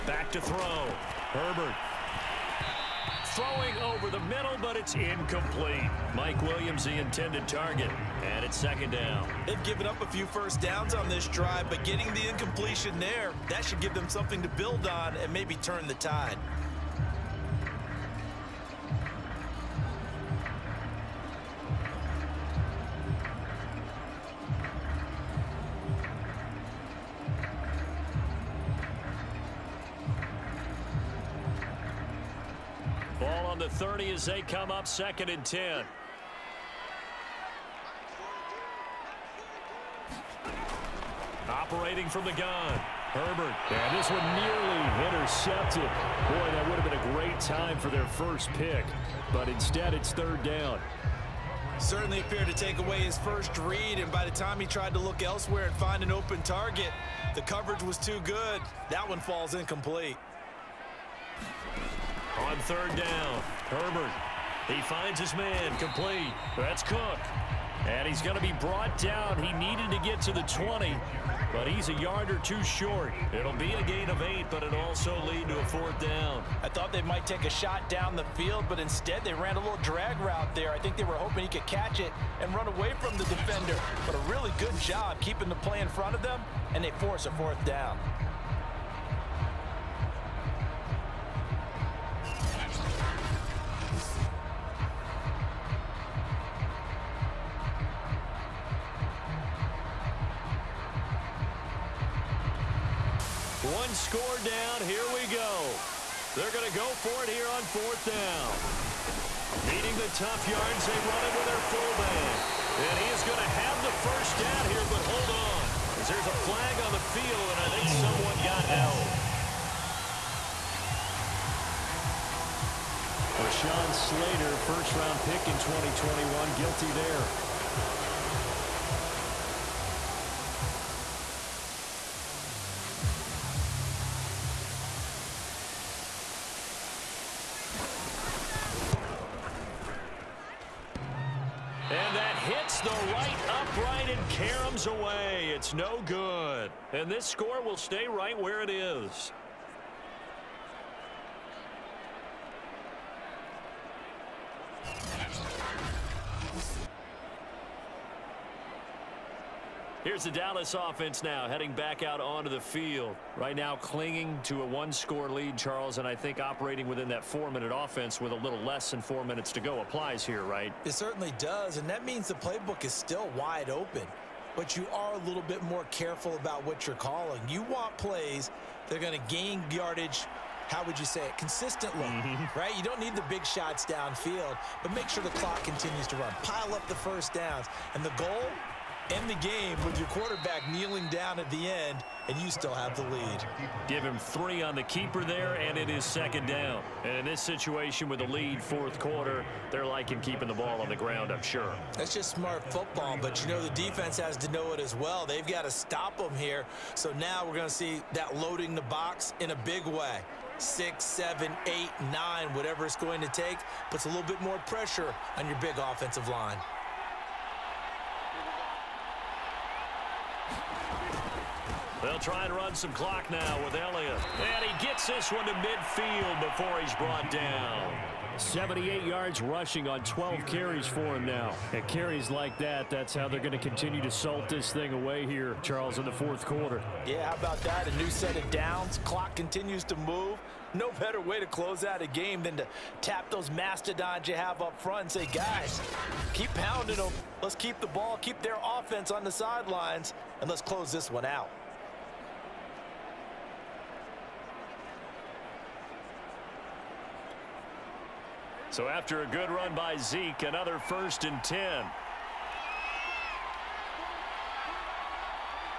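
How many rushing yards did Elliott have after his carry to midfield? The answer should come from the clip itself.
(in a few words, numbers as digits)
78.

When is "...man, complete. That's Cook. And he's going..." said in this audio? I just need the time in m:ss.
1:05.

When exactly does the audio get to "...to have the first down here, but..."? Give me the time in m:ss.
1:53.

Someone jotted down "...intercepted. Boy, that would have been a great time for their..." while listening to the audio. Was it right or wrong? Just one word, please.
right.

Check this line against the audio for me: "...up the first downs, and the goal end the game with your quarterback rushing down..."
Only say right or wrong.
wrong.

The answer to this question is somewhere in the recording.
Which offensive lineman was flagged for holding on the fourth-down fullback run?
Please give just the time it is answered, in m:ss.
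2:03.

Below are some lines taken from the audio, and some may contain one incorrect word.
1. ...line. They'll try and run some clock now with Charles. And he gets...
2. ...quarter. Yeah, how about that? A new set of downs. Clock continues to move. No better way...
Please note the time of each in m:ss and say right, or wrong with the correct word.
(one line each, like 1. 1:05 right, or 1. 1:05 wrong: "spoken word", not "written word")
1. 3:36 wrong: "Elliott", not "Charles"
2. 3:56 right.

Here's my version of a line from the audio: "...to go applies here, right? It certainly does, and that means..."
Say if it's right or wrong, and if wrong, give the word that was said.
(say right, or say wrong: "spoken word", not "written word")
right.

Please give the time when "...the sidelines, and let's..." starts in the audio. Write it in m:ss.
4:09.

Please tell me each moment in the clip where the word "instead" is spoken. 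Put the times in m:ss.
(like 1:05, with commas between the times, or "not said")
0:49, 1:18.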